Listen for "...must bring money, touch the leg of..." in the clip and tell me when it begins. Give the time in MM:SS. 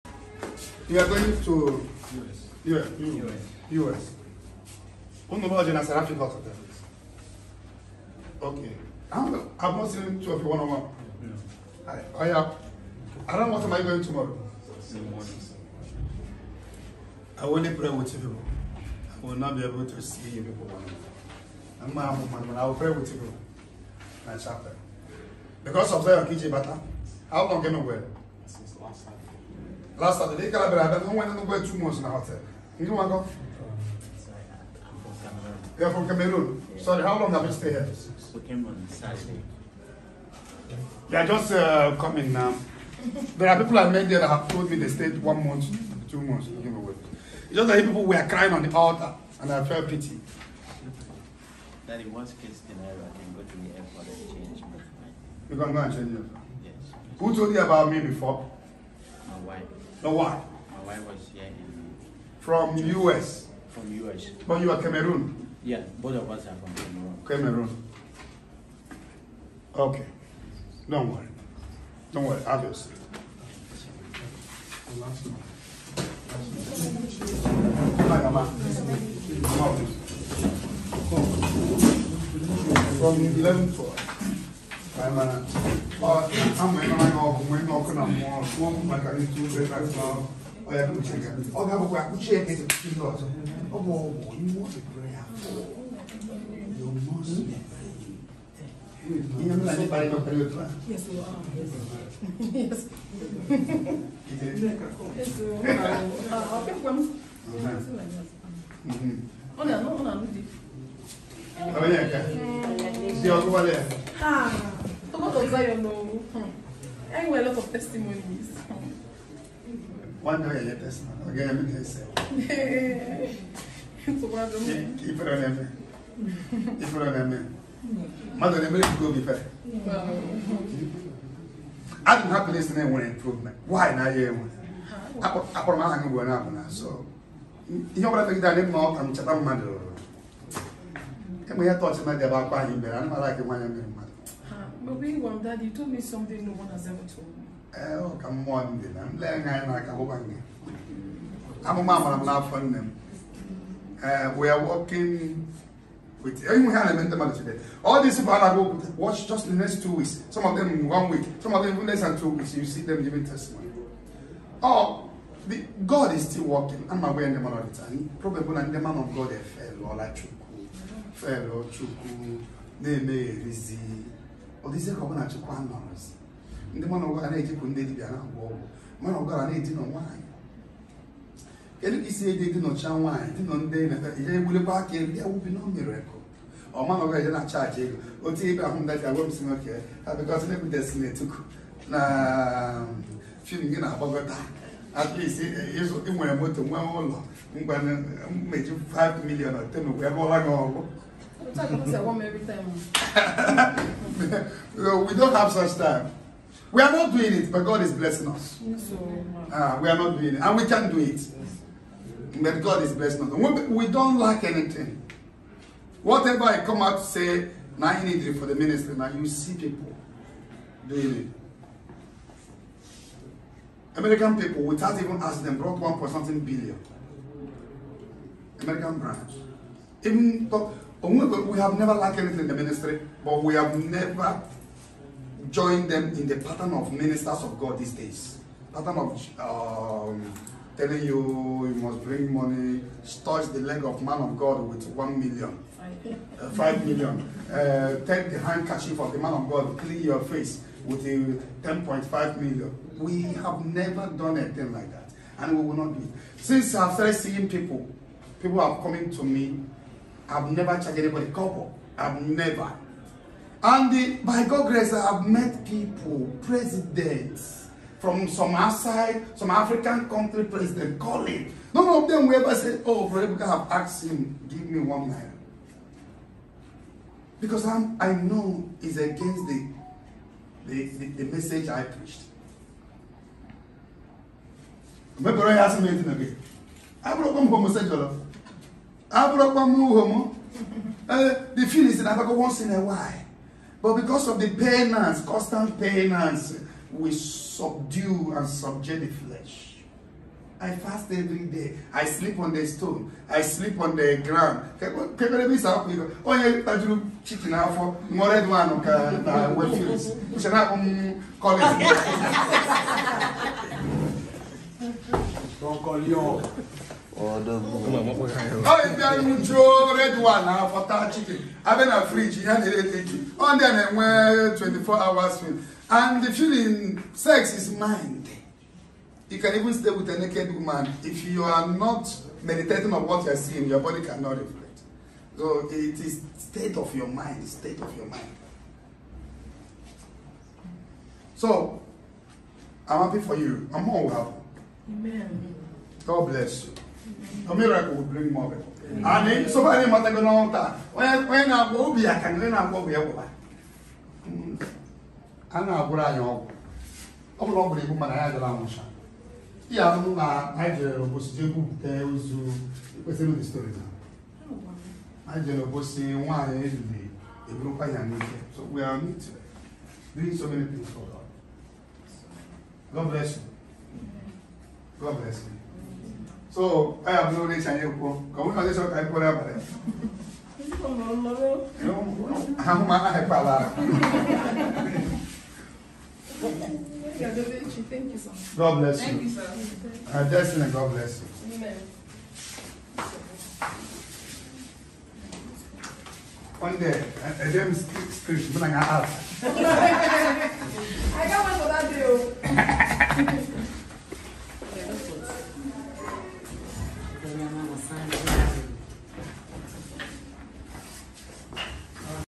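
04:01.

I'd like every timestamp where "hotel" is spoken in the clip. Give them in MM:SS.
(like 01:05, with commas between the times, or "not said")
00:06, 00:32.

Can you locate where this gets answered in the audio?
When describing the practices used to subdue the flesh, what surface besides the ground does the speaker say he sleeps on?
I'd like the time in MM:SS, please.
05:02.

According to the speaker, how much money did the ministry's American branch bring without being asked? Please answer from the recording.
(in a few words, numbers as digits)
one point something billion.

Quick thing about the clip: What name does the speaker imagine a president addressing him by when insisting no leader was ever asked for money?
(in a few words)
Rebecca.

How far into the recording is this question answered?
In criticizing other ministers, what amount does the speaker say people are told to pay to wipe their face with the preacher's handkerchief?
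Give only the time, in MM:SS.
04:11.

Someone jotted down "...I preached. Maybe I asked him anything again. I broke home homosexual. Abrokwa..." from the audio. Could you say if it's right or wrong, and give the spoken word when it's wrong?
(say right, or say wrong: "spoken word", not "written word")
right.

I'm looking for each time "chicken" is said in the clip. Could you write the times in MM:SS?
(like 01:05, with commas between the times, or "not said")
05:07, 05:21.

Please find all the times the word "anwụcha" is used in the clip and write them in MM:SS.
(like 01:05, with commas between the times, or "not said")
05:58.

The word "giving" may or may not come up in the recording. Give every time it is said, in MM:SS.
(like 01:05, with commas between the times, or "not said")
02:43.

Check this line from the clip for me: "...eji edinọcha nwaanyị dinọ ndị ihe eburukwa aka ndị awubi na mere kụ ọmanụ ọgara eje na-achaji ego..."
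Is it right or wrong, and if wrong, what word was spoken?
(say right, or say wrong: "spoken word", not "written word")
wrong: "egbulikwa", not "eburukwa".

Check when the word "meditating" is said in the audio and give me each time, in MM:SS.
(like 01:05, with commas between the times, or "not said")
05:32.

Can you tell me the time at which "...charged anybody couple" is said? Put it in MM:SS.
04:20.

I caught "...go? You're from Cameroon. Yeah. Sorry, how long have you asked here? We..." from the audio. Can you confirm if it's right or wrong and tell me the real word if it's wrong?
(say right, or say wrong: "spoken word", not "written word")
wrong: "stayed", not "asked".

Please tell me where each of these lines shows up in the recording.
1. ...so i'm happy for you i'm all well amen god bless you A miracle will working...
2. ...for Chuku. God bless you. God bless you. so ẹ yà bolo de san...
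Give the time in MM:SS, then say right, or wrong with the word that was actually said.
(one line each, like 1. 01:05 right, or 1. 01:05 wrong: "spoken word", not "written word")
1. 05:41 wrong: "bring", not "working"
2. 06:10 wrong: "God", not "Chuku".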